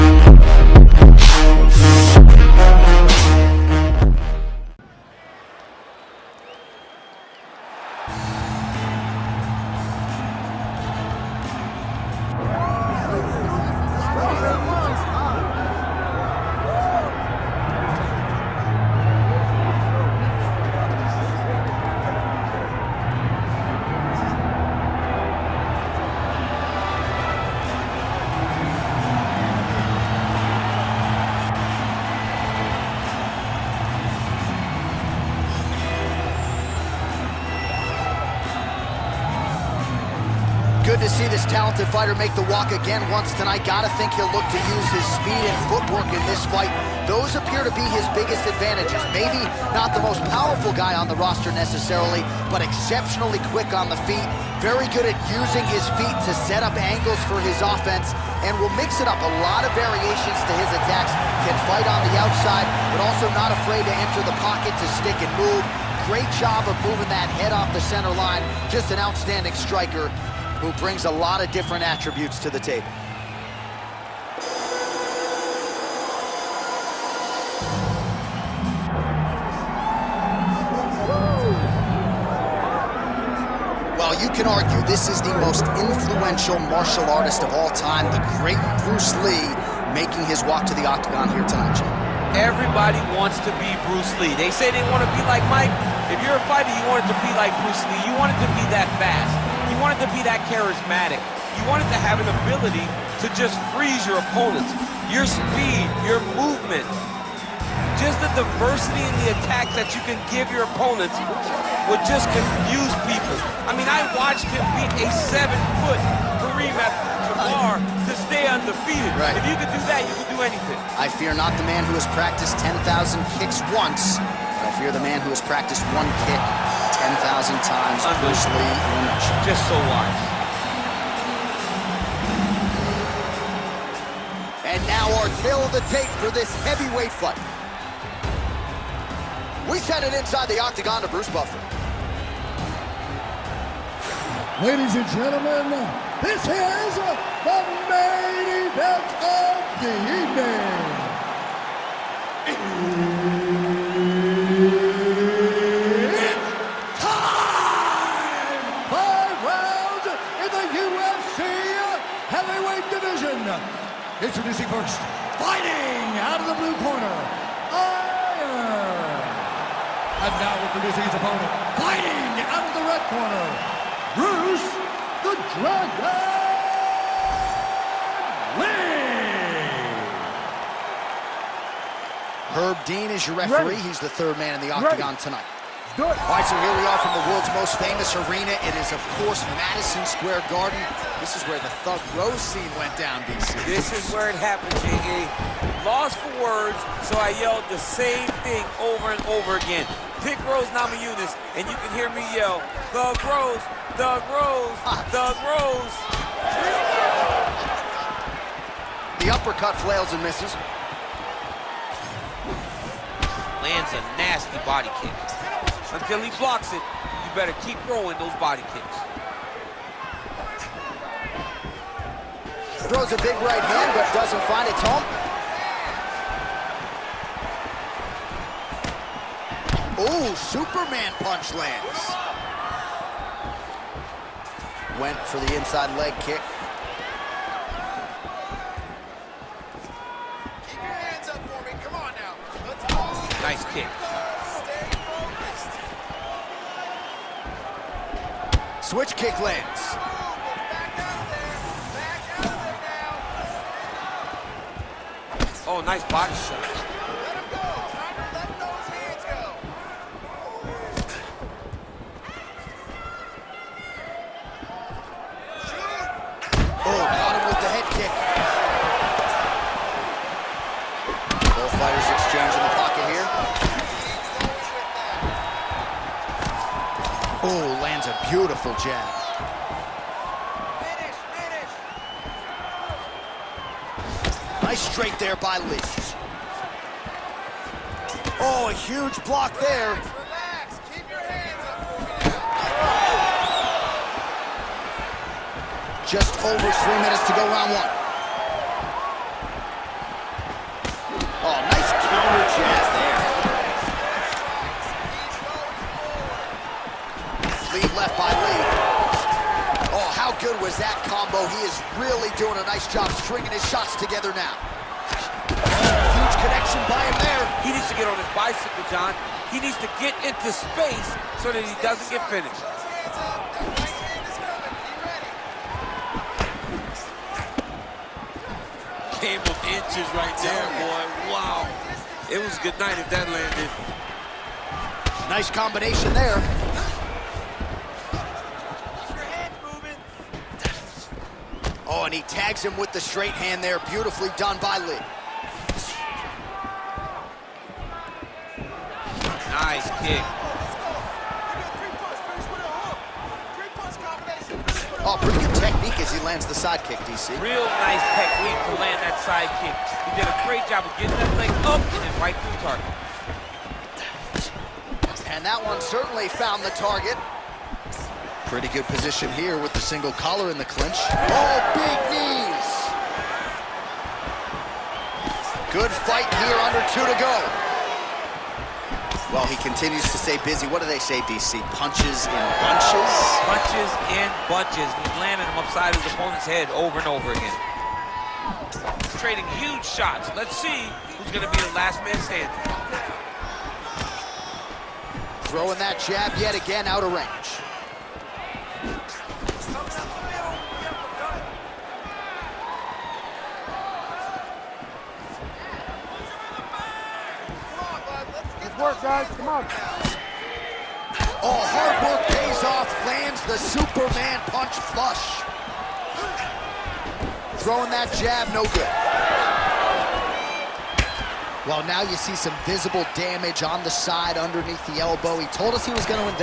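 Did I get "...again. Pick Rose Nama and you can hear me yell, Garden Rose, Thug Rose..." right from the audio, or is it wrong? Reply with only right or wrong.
wrong.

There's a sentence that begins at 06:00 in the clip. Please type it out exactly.
He did a great job of getting that leg up and then right through target.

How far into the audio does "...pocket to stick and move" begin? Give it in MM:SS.
01:04.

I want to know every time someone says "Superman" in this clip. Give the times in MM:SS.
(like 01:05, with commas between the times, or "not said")
03:50, 06:53.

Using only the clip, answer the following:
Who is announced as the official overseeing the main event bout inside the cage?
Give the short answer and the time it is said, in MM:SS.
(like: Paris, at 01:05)
Herb Dean, at 03:02.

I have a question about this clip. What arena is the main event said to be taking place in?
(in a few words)
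Madison Square Garden.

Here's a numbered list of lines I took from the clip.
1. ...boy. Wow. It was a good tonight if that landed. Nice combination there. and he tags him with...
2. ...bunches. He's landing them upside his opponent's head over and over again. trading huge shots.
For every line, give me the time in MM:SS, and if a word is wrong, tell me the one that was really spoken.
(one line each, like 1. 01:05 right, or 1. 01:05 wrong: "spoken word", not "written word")
1. 05:30 wrong: "night", not "tonight"
2. 06:24 right.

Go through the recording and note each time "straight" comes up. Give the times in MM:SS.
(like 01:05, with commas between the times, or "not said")
04:44, 05:42.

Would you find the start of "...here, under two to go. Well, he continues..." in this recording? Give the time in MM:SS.
06:16.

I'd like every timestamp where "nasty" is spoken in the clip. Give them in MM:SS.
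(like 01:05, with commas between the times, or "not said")
03:34.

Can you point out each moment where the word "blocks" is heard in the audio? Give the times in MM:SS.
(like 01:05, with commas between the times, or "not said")
03:36, 04:49.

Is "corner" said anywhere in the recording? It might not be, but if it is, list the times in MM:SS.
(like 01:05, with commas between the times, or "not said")
02:46, 02:53.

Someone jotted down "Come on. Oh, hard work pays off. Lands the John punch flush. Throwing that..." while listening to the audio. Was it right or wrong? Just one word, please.
wrong.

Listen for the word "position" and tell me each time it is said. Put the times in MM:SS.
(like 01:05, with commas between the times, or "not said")
06:08.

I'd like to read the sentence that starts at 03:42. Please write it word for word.
Throws a big right hand, but doesn't find its home.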